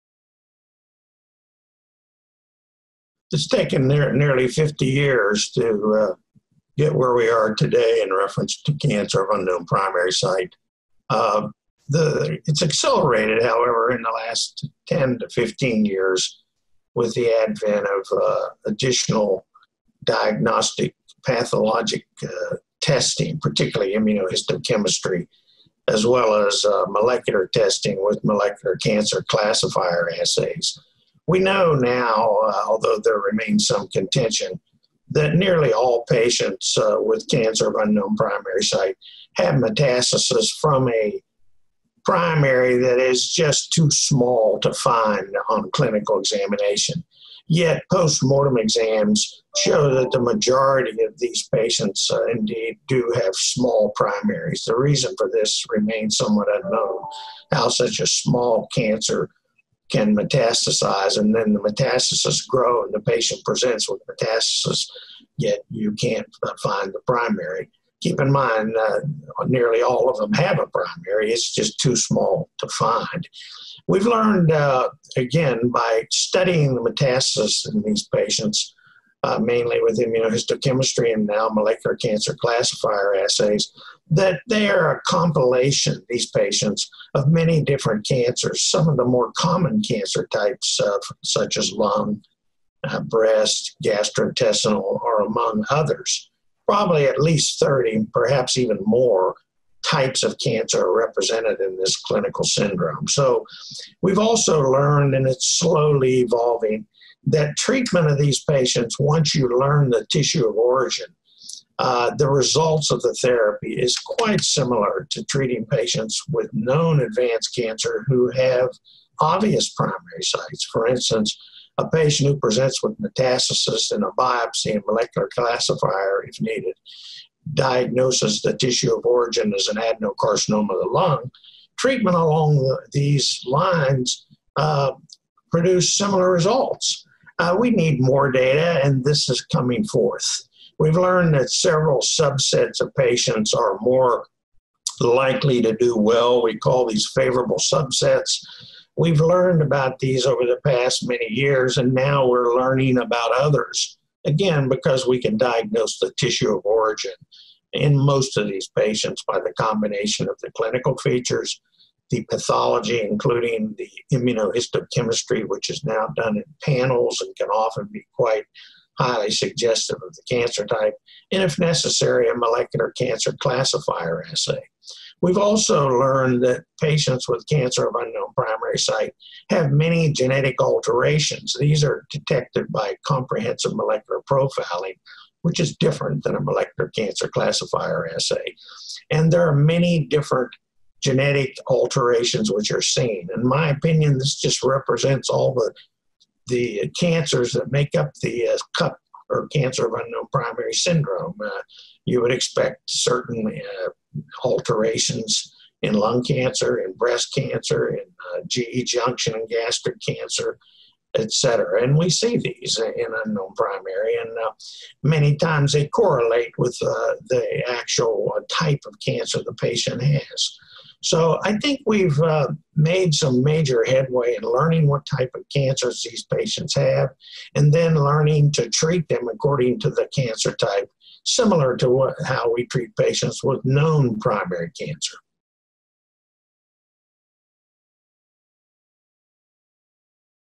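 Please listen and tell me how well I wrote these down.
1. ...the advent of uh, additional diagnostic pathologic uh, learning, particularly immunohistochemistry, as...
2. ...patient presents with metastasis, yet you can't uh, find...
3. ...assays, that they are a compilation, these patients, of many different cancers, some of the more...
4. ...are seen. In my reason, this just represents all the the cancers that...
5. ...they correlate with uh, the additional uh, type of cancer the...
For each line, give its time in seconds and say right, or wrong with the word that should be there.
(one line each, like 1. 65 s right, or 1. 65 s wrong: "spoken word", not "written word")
1. 17 s wrong: "testing", not "learning"
2. 63 s right
3. 83 s right
4. 192 s wrong: "opinion", not "reason"
5. 215 s wrong: "actual", not "additional".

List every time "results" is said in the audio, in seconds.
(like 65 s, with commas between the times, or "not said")
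112 s, 136 s.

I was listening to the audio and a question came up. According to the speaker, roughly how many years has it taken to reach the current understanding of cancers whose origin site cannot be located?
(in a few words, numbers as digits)
50 years.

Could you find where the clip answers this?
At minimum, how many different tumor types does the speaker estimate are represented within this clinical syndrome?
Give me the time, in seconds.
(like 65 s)
97 s.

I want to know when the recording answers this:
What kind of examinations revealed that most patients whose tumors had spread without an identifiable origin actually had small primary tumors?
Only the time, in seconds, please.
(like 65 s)
47 s.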